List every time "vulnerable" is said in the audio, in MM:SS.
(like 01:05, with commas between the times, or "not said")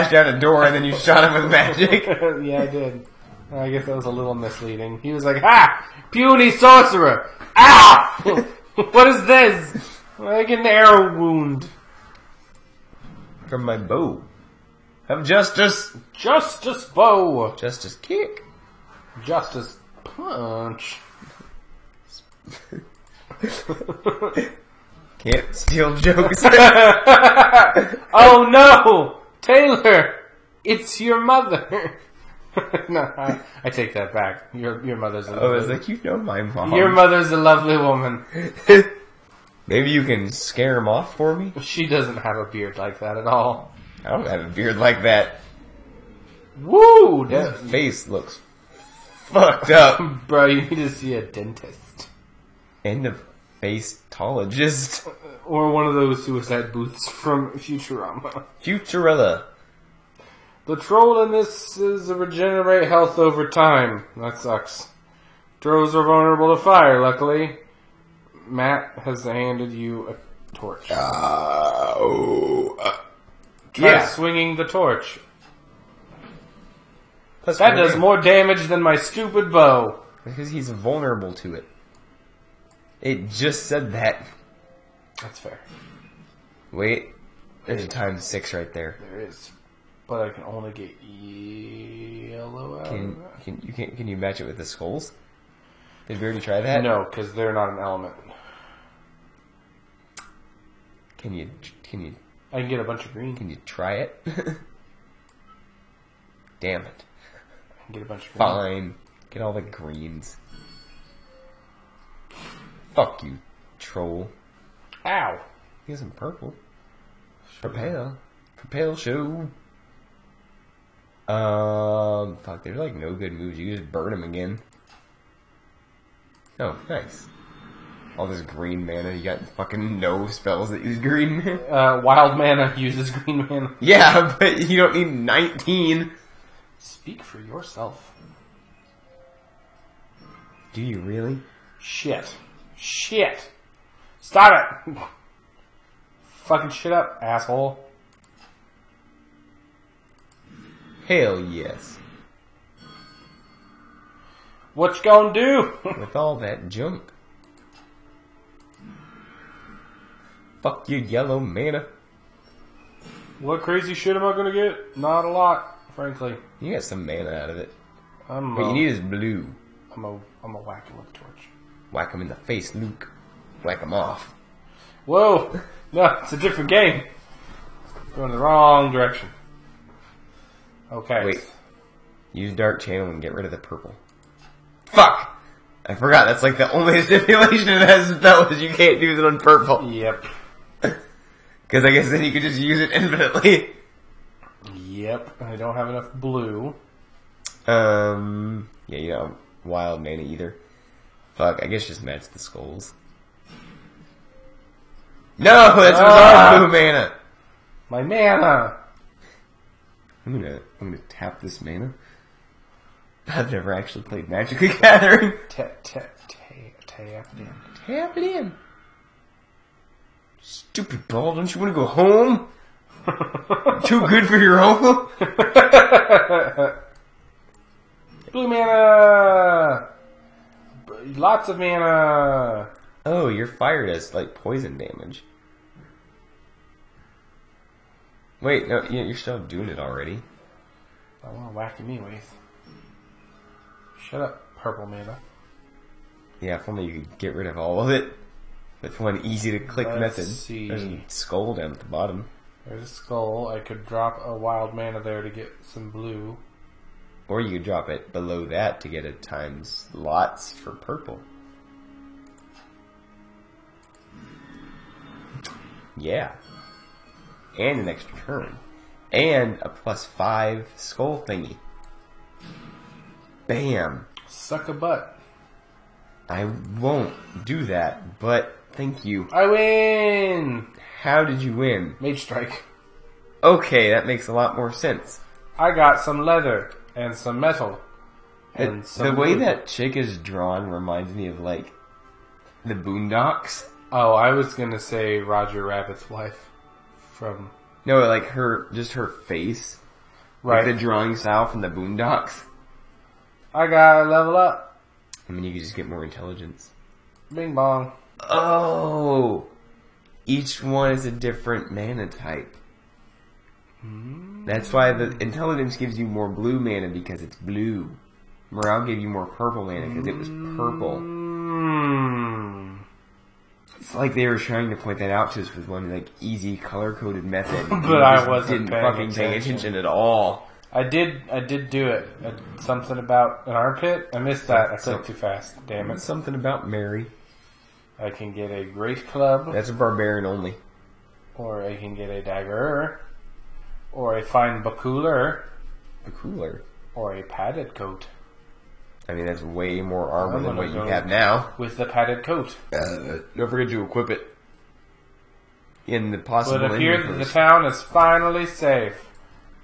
01:06, 01:20.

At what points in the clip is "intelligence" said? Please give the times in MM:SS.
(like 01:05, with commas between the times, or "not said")
05:06, 05:15.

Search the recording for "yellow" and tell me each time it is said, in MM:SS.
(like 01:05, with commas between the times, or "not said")
01:31, 02:40.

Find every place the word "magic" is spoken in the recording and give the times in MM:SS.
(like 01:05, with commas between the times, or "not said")
00:01, 03:34.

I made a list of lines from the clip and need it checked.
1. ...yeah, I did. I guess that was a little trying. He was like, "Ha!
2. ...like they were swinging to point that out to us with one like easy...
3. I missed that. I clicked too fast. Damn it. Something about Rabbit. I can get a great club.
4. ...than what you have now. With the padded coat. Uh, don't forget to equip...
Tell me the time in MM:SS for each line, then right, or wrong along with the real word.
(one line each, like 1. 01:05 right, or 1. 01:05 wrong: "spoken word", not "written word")
1. 00:02 wrong: "misleading", not "trying"
2. 05:23 wrong: "trying", not "swinging"
3. 05:34 wrong: "Mary", not "Rabbit"
4. 05:50 right.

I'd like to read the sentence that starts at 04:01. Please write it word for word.
I want to whack him anyways.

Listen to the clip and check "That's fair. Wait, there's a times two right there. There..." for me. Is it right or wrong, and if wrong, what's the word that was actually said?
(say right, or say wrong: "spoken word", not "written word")
wrong: "six", not "two".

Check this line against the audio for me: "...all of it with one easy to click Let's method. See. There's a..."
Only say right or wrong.
right.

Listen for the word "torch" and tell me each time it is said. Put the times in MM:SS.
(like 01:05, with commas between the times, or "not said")
01:10, 01:14, 02:51.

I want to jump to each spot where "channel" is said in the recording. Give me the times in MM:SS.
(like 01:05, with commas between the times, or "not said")
03:02.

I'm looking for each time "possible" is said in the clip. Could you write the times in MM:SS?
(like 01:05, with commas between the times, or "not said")
05:56.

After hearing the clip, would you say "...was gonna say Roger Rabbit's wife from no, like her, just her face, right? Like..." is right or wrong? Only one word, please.
right.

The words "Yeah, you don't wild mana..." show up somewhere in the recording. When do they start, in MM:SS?
03:18.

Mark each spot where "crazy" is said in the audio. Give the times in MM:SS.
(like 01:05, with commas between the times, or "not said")
02:43.